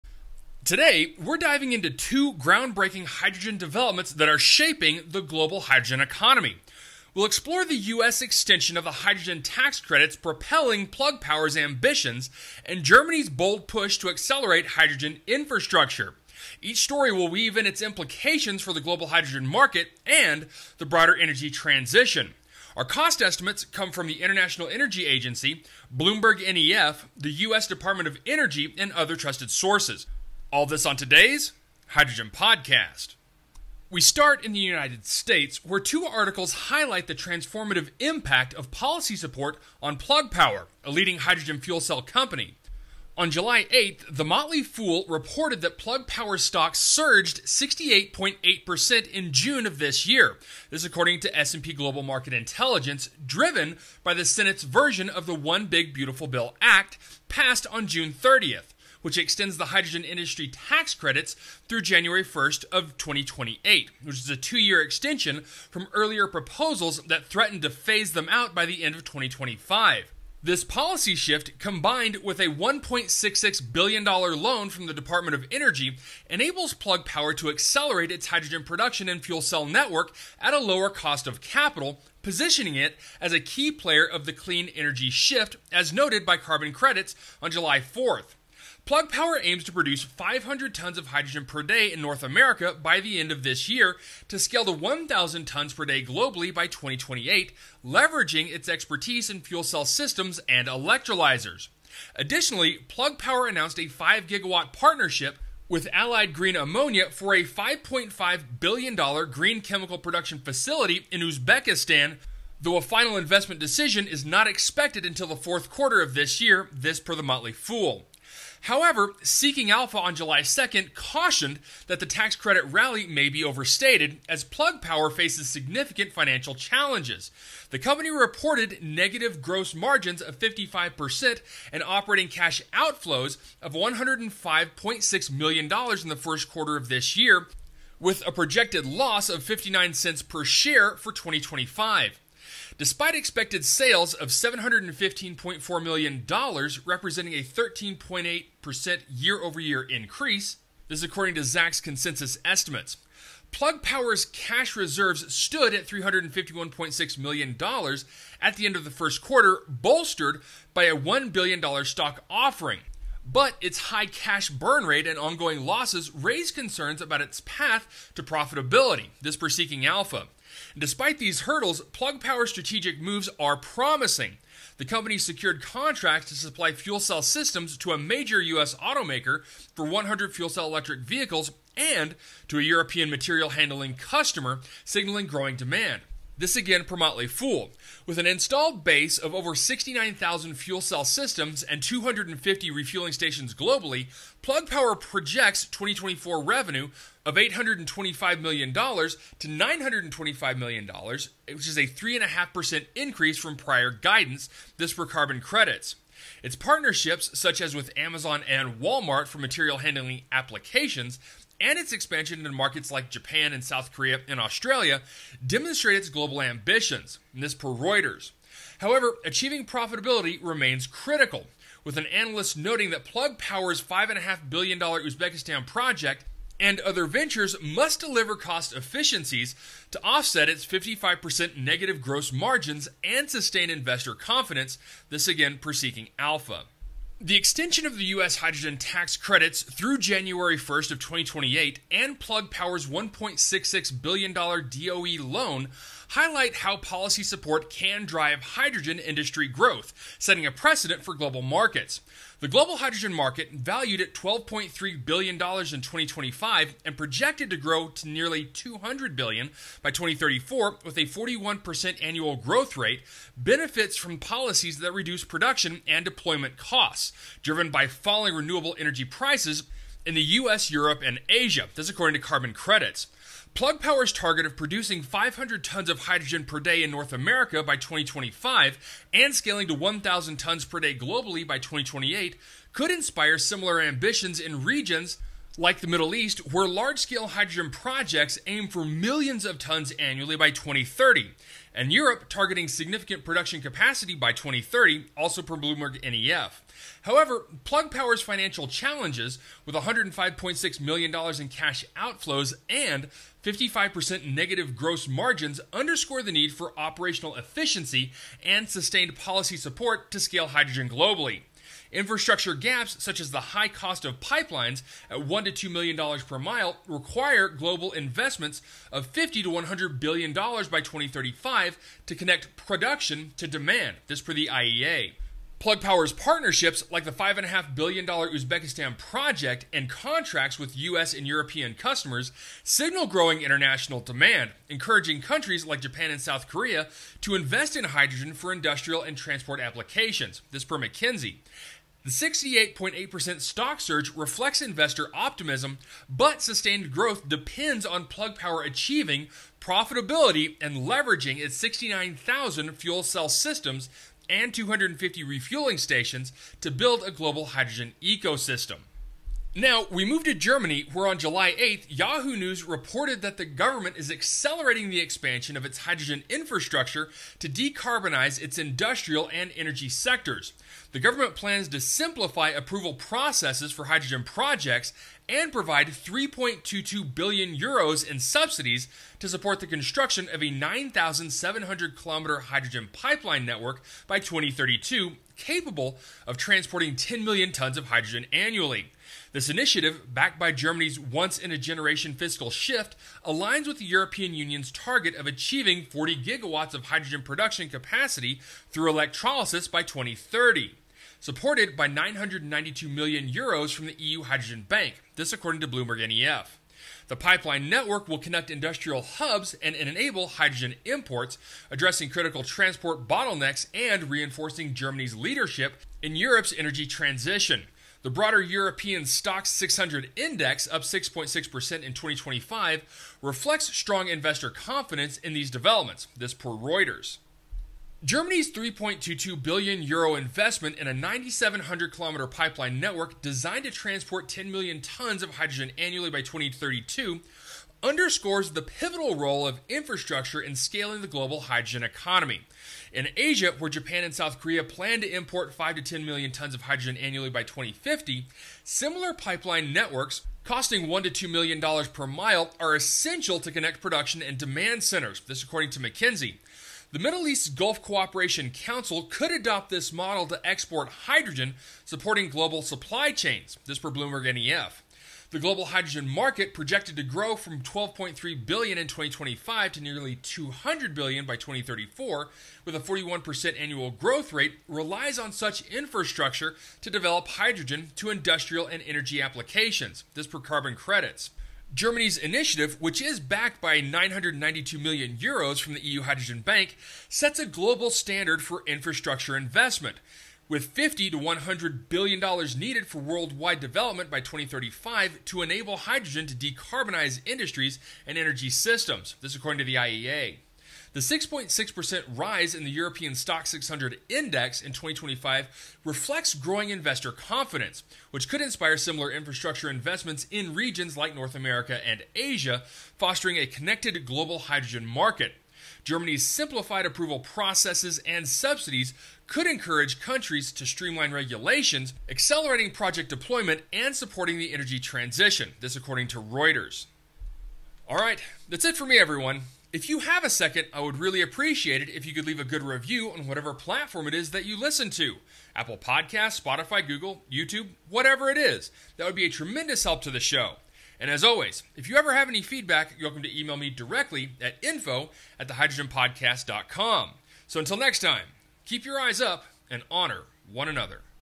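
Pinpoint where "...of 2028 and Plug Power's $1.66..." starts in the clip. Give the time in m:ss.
4:00.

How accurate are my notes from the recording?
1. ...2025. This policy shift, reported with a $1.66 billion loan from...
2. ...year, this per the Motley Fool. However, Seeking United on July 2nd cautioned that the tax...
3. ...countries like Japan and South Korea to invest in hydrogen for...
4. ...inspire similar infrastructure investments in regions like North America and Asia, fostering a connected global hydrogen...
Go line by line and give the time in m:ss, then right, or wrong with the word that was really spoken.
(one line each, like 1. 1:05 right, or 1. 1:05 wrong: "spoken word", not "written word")
1. 1:09 wrong: "combined", not "reported"
2. 1:56 wrong: "Alpha", not "United"
3. 5:35 right
4. 8:28 right.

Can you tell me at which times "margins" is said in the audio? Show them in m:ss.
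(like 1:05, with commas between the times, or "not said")
2:09, 3:52, 5:05.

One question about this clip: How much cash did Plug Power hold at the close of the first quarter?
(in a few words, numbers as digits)
$351.6 million.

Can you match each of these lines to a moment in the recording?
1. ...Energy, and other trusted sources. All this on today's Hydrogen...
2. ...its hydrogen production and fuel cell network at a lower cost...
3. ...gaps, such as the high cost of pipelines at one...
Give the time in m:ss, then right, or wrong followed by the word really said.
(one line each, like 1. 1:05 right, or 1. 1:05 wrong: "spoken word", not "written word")
1. 0:28 right
2. 1:18 right
3. 5:12 right.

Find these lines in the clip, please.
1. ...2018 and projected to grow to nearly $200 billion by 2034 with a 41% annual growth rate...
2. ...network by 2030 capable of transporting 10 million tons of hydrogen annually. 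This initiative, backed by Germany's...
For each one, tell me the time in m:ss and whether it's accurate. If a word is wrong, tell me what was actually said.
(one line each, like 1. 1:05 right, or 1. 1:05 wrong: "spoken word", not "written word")
1. 4:15 wrong: "2025", not "2018"
2. 6:23 wrong: "2032", not "2030".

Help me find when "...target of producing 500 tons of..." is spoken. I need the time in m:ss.
4:34.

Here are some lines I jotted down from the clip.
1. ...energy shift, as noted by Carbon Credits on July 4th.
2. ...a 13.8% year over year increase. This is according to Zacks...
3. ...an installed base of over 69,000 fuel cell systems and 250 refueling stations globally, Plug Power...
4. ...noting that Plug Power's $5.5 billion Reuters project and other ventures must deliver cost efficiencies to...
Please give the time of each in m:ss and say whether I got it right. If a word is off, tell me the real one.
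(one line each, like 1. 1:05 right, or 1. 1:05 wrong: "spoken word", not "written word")
1. 1:24 right
2. 2:27 right
3. 3:08 right
4. 3:42 wrong: "Uzbekistan", not "Reuters".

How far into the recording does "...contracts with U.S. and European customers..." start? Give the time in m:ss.
5:29.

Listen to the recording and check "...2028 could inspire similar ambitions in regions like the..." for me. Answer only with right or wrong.
right.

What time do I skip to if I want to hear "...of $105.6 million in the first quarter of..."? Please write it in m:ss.
2:13.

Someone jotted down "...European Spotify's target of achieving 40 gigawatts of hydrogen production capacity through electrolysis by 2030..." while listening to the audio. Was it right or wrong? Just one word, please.
wrong.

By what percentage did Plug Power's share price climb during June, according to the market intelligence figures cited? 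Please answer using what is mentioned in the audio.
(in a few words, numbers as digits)
68.8%.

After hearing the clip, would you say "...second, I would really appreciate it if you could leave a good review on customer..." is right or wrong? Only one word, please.
wrong.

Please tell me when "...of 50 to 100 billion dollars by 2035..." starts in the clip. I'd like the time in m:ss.
5:18.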